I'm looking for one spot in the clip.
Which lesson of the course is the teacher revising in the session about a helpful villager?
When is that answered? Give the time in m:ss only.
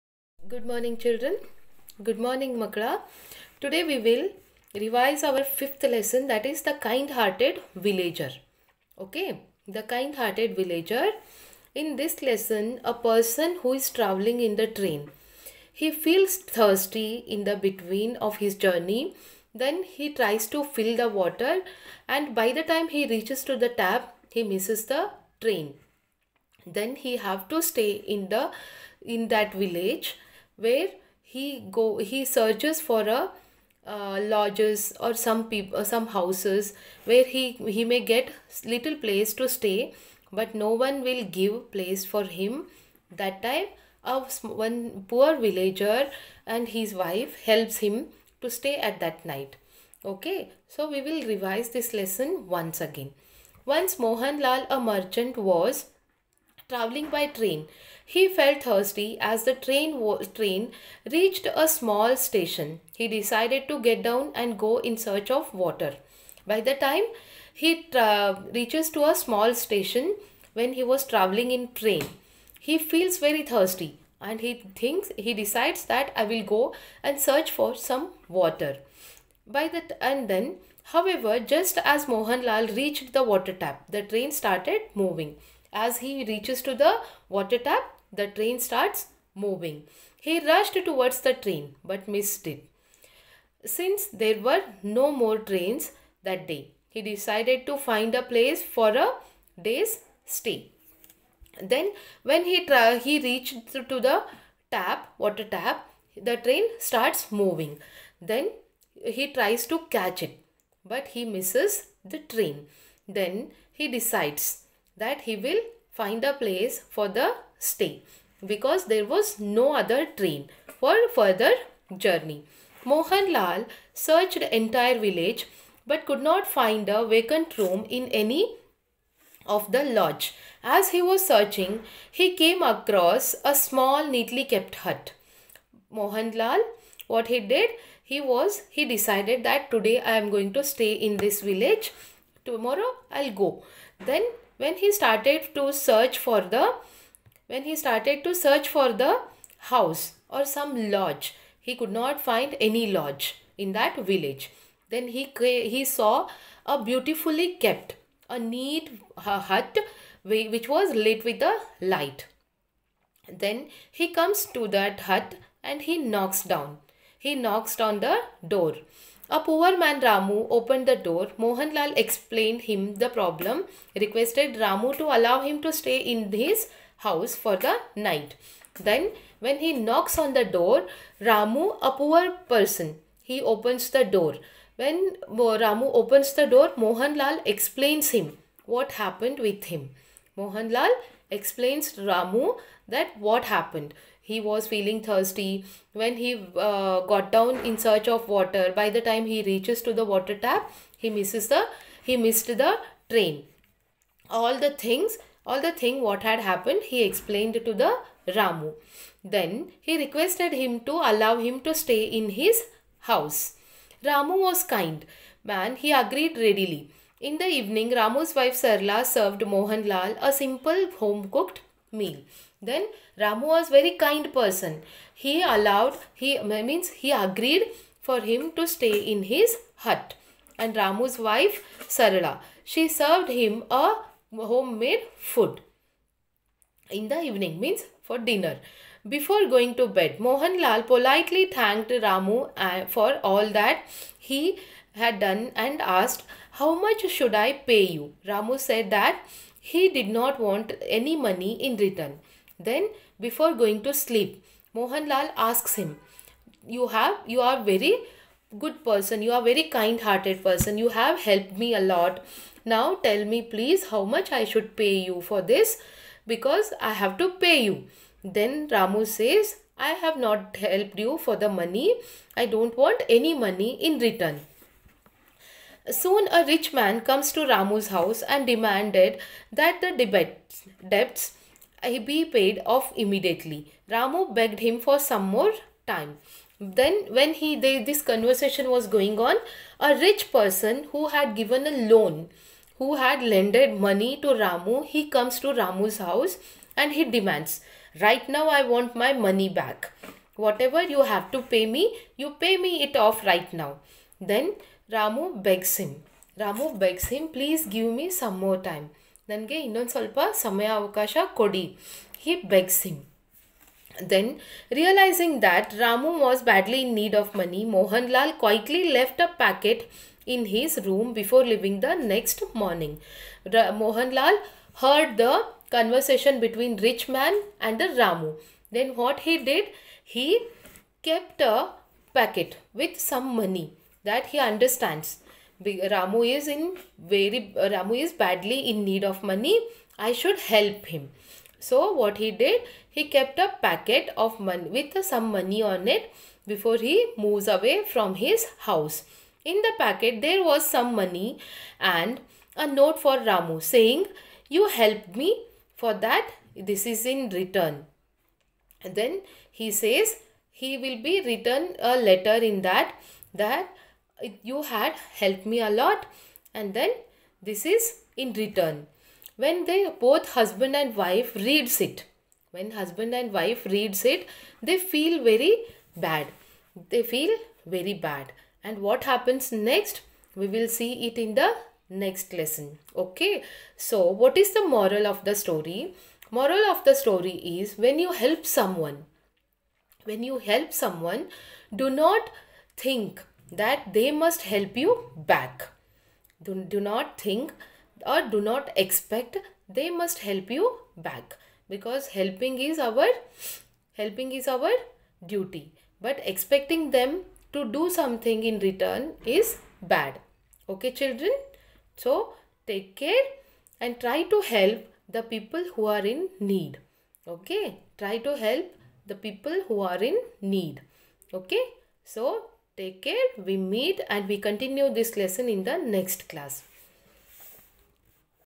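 0:05.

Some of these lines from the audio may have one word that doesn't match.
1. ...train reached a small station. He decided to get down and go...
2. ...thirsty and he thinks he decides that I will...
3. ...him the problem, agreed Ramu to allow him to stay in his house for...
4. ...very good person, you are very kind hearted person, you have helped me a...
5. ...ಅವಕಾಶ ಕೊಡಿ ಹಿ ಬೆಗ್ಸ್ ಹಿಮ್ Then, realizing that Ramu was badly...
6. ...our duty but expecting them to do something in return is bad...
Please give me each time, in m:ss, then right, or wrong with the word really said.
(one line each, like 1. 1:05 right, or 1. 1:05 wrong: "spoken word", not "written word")
1. 1:00 right
2. 1:13 right
3. 2:52 wrong: "requested", not "agreed"
4. 4:17 right
5. 5:10 right
6. 6:44 right.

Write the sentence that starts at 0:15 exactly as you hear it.
He feels thirsty in the between of his journey.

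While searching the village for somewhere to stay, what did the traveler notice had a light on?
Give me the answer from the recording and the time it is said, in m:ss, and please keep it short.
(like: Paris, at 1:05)
A neat hut, at 2:38.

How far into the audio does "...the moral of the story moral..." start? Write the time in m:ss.
6:24.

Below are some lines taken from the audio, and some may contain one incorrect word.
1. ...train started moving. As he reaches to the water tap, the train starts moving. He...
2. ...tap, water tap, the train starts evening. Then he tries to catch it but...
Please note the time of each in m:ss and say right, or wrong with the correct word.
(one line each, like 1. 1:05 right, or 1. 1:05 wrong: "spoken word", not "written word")
1. 1:24 right
2. 1:44 wrong: "moving", not "evening".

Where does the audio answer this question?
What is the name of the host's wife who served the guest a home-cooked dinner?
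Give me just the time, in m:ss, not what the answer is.
3:38.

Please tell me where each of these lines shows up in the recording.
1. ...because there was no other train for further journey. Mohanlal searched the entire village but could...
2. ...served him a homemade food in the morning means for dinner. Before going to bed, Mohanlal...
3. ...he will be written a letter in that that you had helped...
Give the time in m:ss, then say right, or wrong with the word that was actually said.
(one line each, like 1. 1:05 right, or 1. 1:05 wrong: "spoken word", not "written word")
1. 1:58 right
2. 3:52 wrong: "evening", not "morning"
3. 6:00 right.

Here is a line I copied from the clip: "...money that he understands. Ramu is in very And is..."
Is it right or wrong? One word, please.
wrong.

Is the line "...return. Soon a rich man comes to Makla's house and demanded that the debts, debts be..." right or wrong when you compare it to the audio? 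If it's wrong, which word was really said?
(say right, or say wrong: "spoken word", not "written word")
wrong: "Ramu", not "Makla".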